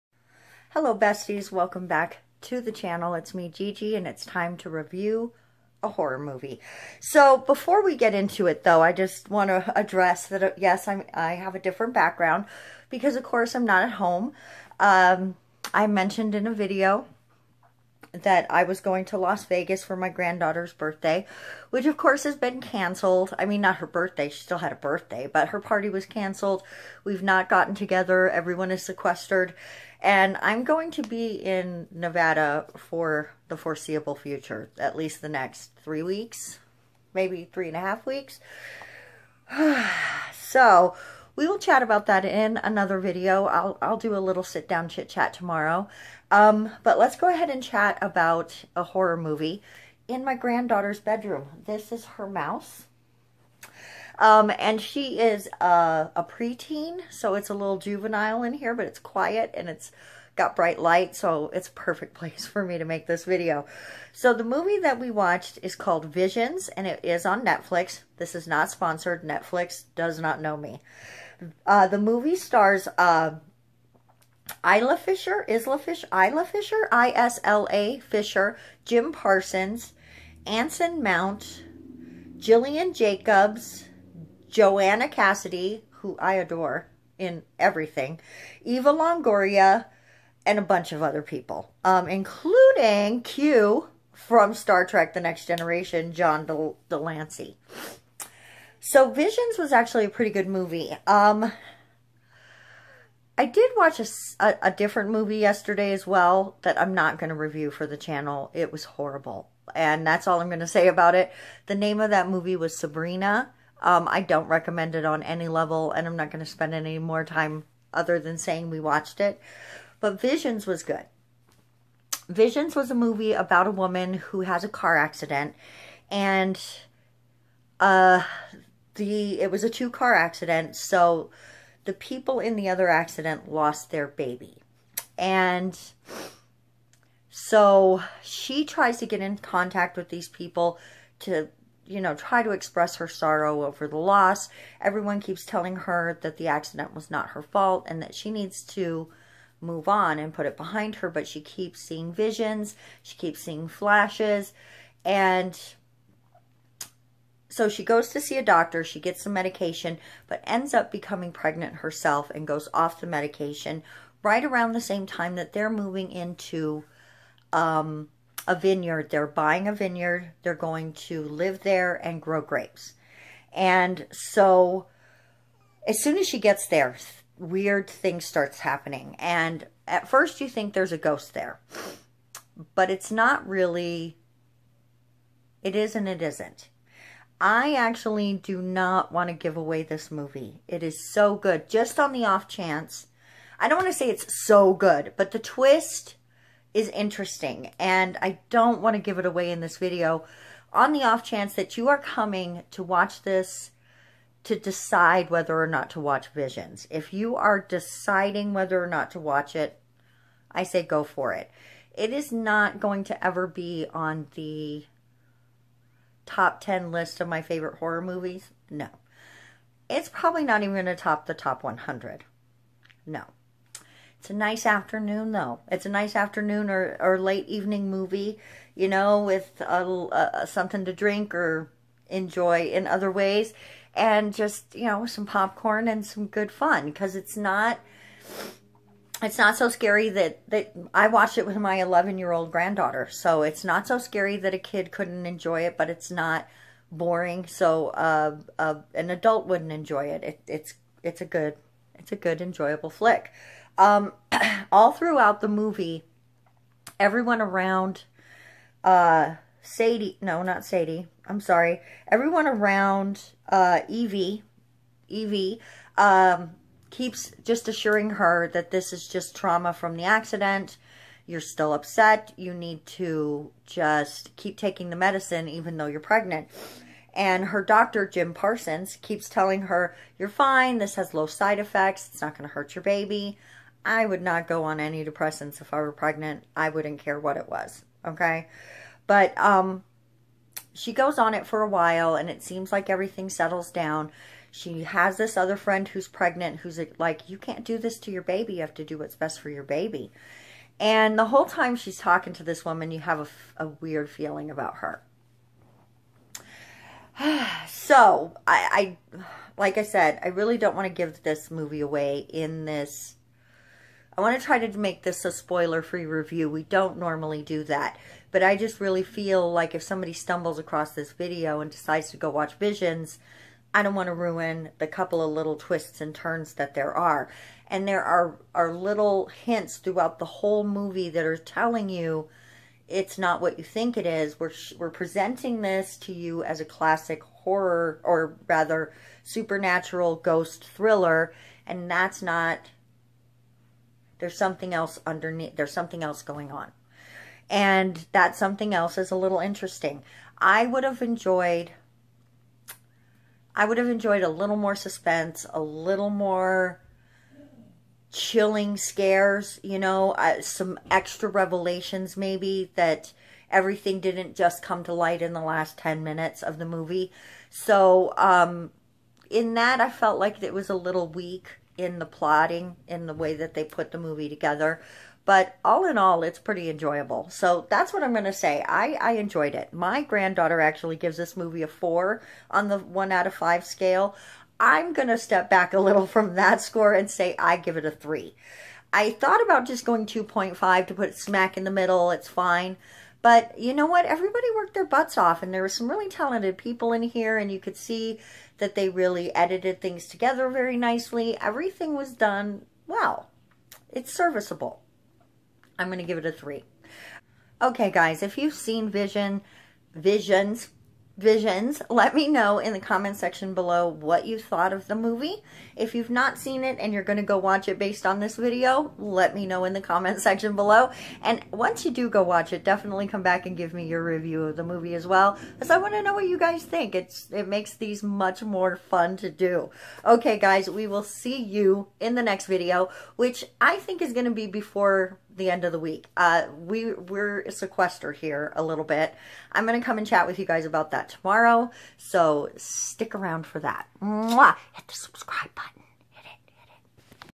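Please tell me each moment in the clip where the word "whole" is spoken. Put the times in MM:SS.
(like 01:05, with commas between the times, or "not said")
05:01, 05:30.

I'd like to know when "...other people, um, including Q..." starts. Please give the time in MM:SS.
01:31.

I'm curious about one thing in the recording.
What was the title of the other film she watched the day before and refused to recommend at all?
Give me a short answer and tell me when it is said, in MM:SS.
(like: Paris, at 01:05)
Sabrina, at 01:52.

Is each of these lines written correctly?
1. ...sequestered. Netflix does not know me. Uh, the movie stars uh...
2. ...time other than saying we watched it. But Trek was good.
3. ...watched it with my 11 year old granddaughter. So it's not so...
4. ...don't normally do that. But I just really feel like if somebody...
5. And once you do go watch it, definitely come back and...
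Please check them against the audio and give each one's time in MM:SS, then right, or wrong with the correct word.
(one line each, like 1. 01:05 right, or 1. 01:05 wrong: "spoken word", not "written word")
1. 01:08 wrong: "sponsored", not "sequestered"
2. 01:57 wrong: "Visions", not "Trek"
3. 04:01 right
4. 05:16 right
5. 07:01 right.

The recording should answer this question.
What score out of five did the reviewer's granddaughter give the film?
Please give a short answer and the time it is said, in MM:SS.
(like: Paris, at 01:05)
4, at 06:21.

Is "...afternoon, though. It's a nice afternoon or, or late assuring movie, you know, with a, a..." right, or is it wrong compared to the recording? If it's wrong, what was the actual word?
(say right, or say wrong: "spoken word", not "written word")
wrong: "evening", not "assuring".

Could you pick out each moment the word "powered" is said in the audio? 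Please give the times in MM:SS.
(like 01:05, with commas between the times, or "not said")
not said.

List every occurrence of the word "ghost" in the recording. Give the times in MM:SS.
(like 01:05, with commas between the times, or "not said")
03:00, 05:40.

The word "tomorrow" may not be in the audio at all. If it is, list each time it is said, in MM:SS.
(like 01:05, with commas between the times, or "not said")
00:45, 07:21.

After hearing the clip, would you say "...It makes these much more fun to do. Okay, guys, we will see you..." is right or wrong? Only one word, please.
right.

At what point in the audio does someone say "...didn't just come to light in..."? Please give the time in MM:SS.
06:03.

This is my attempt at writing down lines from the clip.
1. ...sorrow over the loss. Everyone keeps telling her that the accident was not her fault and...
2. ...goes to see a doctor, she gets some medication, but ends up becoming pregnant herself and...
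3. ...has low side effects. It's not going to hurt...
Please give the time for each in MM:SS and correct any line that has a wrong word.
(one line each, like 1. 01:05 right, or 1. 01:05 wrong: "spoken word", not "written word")
1. 02:23 right
2. 02:37 right
3. 04:40 right.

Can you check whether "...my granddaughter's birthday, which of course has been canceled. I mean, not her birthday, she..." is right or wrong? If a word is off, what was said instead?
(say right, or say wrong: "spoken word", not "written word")
right.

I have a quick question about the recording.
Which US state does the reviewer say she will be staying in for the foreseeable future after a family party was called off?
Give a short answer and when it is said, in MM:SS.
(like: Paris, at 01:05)
Nevada, at 00:31.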